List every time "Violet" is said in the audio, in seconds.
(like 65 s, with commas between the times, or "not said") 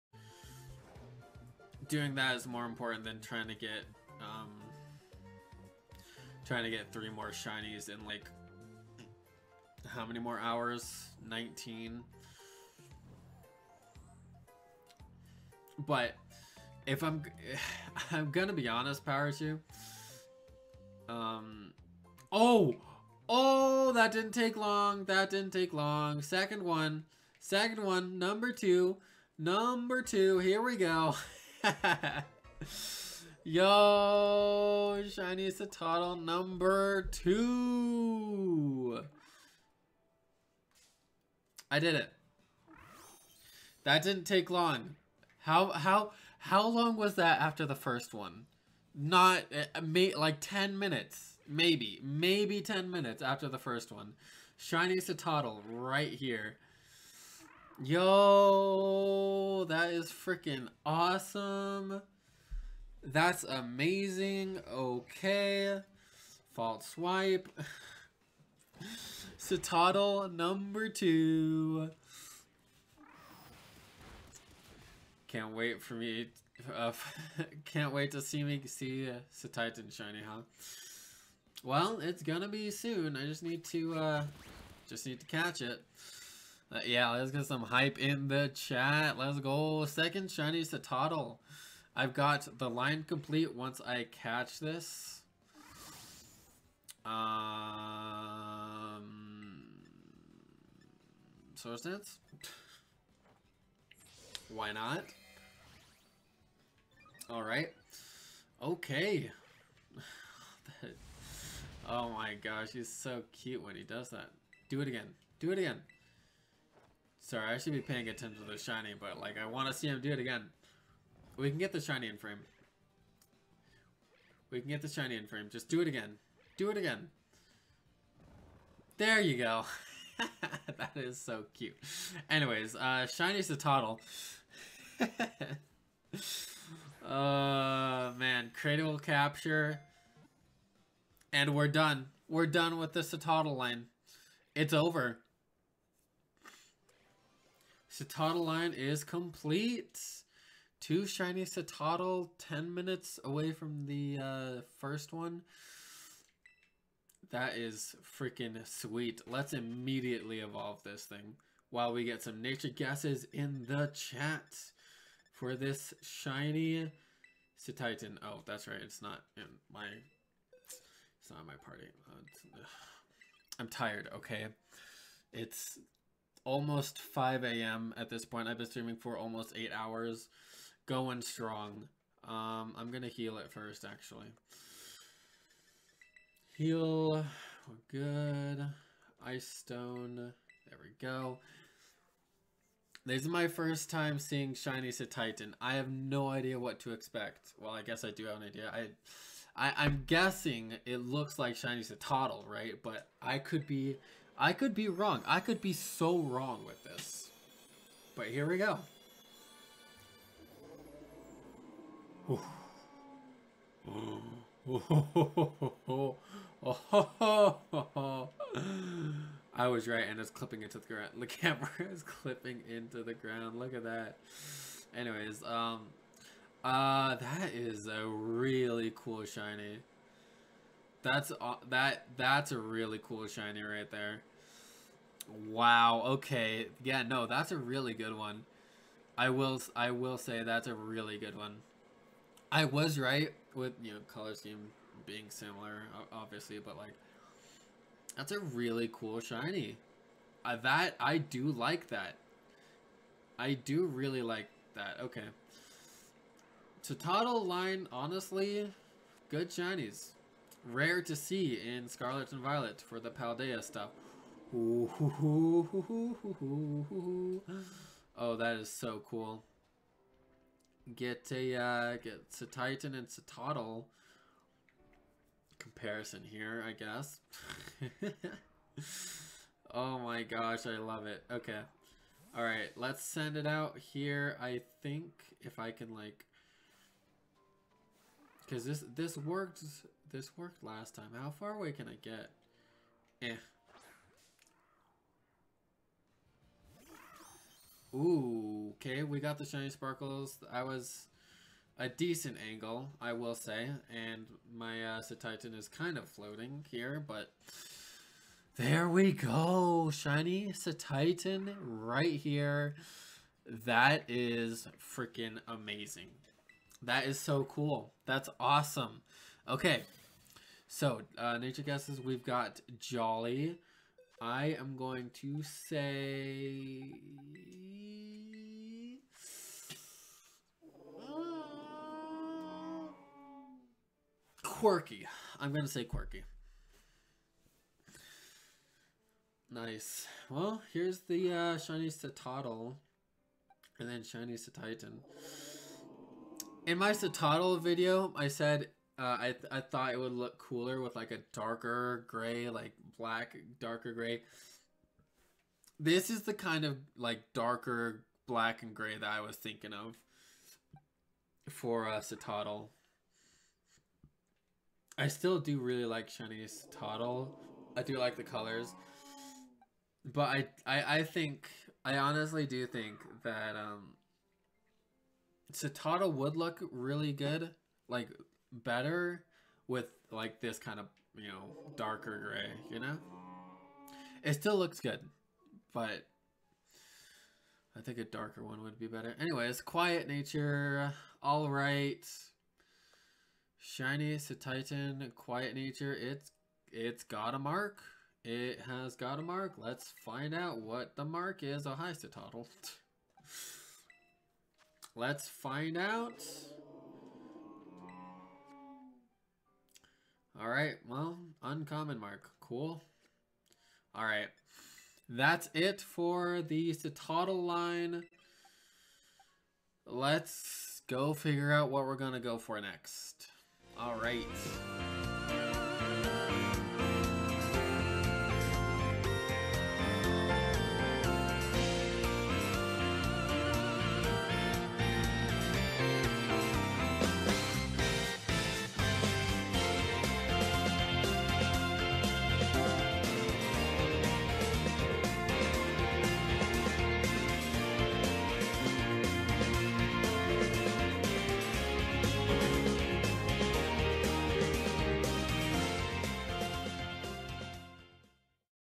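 262 s.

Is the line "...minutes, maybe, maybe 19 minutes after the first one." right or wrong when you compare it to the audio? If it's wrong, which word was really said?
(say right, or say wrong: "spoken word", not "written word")
wrong: "10", not "19".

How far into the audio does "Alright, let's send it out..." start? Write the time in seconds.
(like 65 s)
282 s.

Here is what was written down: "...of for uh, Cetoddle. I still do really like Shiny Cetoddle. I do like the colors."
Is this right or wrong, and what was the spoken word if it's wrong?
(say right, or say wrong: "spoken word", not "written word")
right.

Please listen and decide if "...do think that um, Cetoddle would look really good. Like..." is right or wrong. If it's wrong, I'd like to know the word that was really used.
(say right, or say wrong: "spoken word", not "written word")
right.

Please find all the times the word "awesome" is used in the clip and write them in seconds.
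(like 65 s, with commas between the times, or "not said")
60 s, 318 s.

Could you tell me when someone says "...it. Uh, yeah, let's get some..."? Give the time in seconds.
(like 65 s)
85 s.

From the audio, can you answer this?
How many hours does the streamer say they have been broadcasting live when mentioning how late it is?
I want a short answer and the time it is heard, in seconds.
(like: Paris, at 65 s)
8, at 179 s.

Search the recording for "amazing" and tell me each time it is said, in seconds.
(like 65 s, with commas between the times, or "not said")
63 s, 315 s.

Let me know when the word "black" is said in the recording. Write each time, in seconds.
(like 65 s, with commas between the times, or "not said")
352 s, 358 s.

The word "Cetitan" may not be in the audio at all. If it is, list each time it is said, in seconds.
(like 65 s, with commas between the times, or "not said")
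79 s, 167 s, 194 s, 305 s, 310 s, 344 s, 394 s.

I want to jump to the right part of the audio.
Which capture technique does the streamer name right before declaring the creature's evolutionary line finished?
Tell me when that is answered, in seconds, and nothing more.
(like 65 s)
138 s.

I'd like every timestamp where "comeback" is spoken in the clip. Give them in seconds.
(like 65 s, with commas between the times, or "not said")
not said.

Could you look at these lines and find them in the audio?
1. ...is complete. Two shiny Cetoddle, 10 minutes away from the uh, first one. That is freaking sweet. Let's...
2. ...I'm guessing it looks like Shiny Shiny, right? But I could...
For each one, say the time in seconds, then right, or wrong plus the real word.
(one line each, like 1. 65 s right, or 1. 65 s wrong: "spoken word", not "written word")
1. 148 s right
2. 199 s wrong: "Cetoddle", not "Shiny".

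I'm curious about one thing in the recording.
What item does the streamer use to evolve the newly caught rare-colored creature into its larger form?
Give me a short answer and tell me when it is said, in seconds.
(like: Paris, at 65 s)
Ice stone, at 189 s.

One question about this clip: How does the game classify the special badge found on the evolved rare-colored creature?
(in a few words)
Uncommon mark.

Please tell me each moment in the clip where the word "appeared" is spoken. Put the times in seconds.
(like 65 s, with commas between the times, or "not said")
not said.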